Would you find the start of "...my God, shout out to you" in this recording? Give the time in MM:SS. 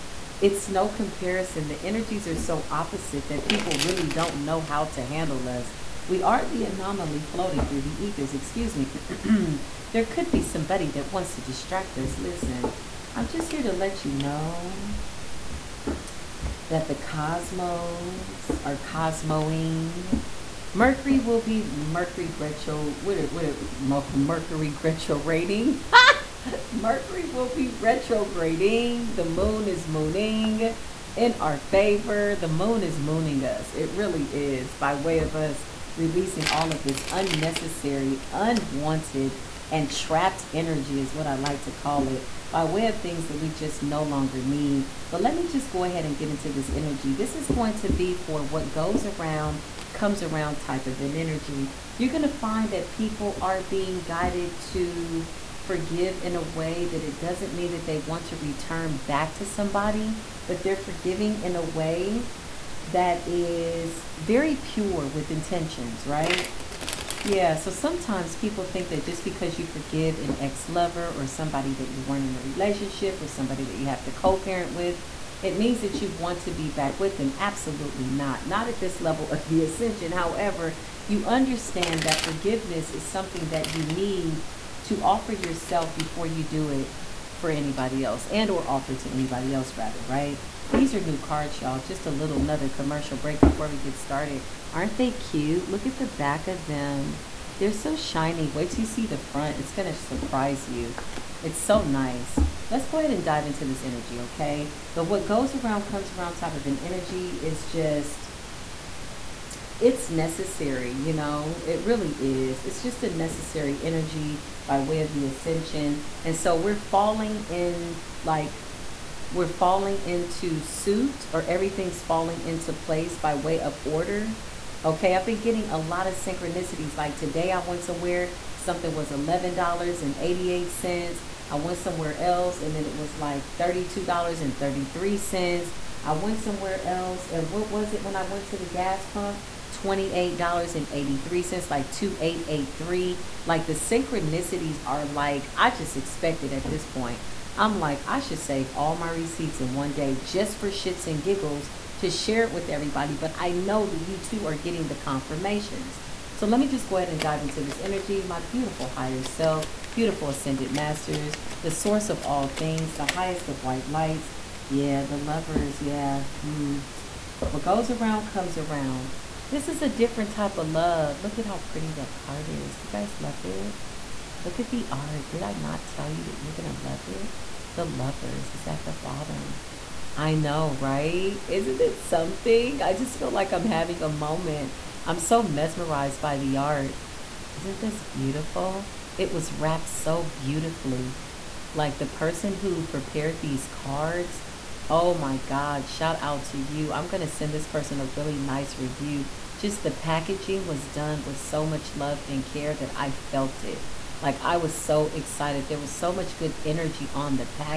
03:15.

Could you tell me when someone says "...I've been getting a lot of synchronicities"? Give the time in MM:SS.
02:05.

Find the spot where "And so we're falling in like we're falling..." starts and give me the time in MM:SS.
01:56.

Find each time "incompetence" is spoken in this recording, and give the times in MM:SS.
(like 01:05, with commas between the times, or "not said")
not said.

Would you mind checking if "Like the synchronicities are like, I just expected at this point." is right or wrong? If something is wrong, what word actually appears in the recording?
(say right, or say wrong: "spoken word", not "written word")
right.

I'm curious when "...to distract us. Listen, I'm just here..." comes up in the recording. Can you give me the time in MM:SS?
00:11.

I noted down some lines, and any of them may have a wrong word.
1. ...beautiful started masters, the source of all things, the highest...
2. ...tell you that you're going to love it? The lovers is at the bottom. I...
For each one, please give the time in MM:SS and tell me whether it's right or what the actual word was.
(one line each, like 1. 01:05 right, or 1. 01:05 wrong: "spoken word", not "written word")
1. 02:39 wrong: "ascended", not "started"
2. 02:55 right.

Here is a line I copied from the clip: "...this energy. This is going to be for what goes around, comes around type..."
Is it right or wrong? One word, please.
right.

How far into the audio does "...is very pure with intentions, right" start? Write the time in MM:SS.
01:03.